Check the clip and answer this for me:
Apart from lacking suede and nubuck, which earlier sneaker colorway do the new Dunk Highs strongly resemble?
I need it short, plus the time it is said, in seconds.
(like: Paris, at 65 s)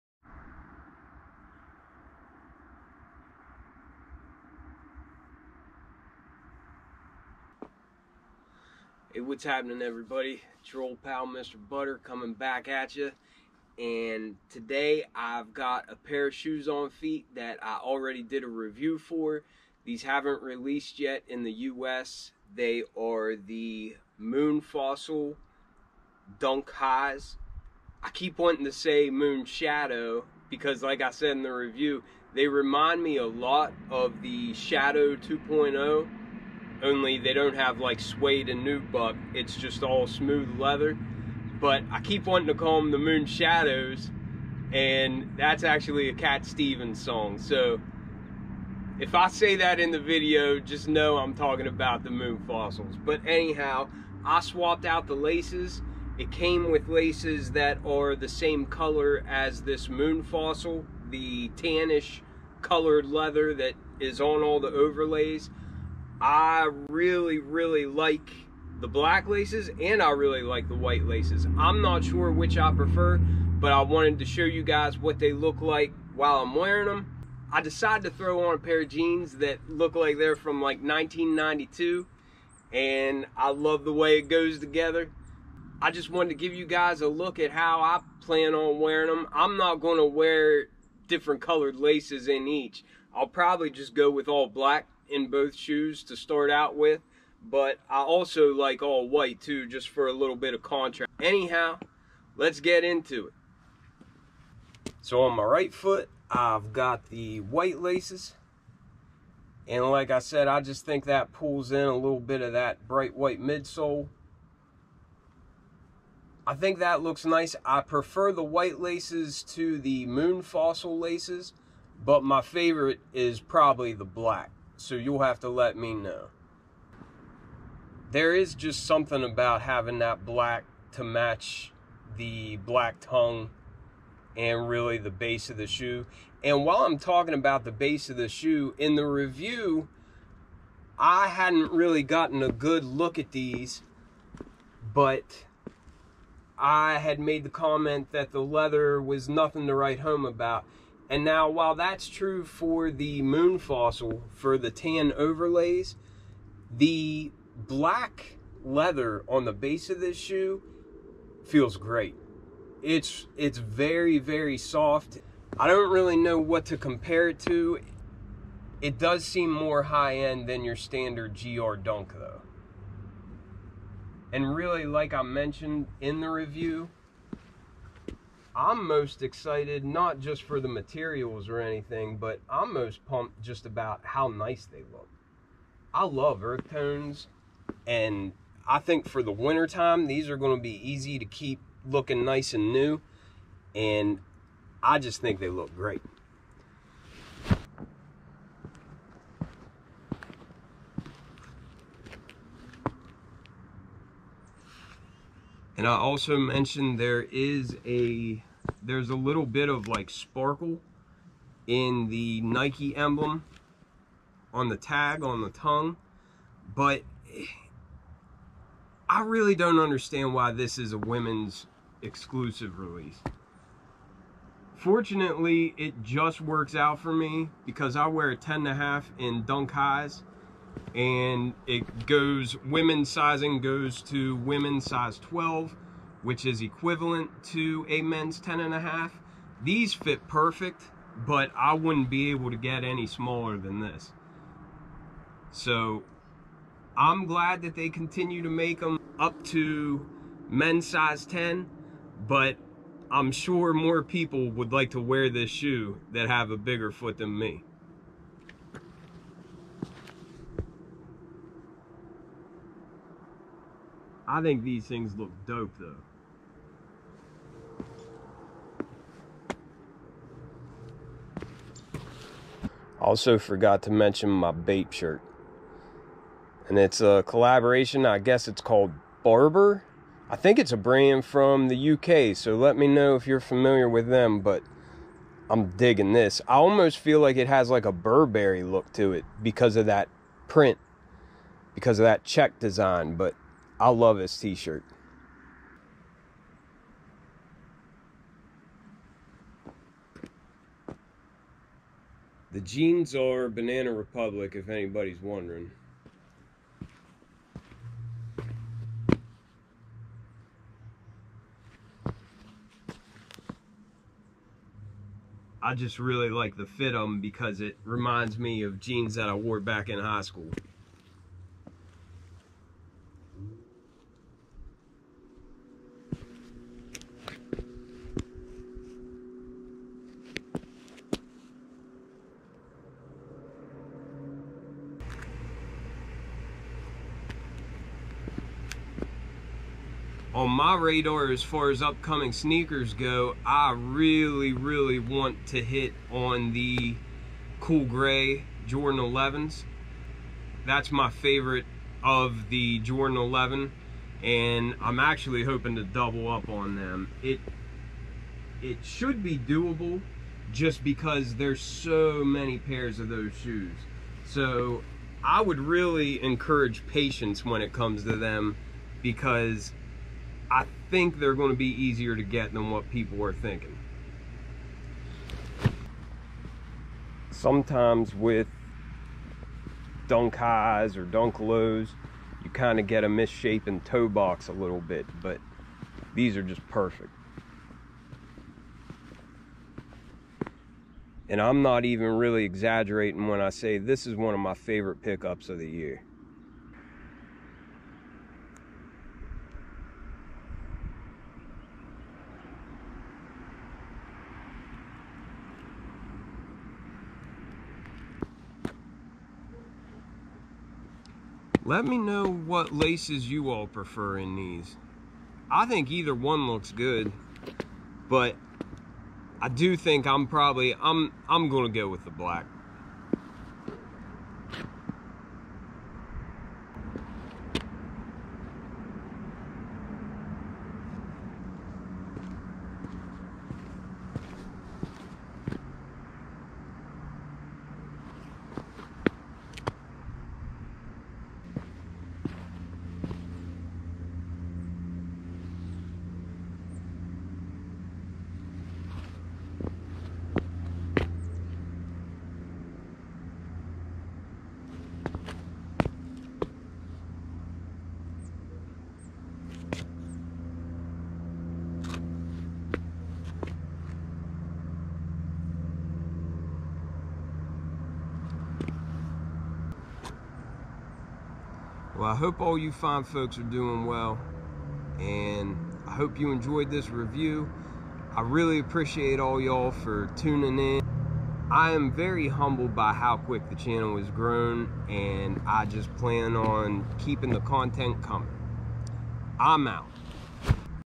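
Shadow 2.0, at 34 s.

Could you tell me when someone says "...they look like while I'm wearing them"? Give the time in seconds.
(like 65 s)
75 s.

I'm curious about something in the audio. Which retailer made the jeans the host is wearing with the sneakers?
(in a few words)
Banana Republic.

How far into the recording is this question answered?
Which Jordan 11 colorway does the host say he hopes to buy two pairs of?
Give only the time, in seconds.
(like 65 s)
347 s.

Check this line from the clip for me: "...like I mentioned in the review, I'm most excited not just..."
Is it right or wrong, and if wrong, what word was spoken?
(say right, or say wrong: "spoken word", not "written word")
right.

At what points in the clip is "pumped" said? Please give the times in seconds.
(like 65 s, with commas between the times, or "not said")
183 s.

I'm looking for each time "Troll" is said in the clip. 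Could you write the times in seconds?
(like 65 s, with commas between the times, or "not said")
10 s.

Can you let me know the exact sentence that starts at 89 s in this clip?
I'm not going to wear different colored laces in each.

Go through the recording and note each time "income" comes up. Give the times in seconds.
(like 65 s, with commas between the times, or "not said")
not said.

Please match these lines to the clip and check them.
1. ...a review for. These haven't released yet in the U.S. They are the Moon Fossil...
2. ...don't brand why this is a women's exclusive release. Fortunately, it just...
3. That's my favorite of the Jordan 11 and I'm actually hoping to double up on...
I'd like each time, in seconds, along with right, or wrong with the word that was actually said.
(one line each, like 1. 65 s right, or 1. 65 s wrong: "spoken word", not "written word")
1. 18 s right
2. 219 s wrong: "understand", not "brand"
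3. 350 s right.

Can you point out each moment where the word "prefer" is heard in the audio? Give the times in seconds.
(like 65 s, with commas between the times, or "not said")
72 s, 117 s, 413 s.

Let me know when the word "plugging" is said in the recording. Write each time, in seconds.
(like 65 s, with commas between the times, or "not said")
not said.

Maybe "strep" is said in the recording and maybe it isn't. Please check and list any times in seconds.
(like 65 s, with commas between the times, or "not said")
not said.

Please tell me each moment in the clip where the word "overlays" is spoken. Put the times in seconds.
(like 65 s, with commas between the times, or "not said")
64 s, 155 s.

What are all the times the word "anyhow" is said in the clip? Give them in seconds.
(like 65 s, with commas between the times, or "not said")
53 s, 101 s.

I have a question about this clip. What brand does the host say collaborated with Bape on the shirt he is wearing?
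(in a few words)
Barbour.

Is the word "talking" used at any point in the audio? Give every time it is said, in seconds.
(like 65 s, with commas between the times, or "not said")
51 s, 136 s.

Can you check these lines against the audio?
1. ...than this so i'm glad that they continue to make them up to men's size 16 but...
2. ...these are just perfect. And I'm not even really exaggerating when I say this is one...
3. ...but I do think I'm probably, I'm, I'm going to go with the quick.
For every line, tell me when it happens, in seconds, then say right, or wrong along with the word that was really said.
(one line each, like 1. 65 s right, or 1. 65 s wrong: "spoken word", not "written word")
1. 243 s wrong: "10", not "16"
2. 386 s right
3. 418 s wrong: "black", not "quick".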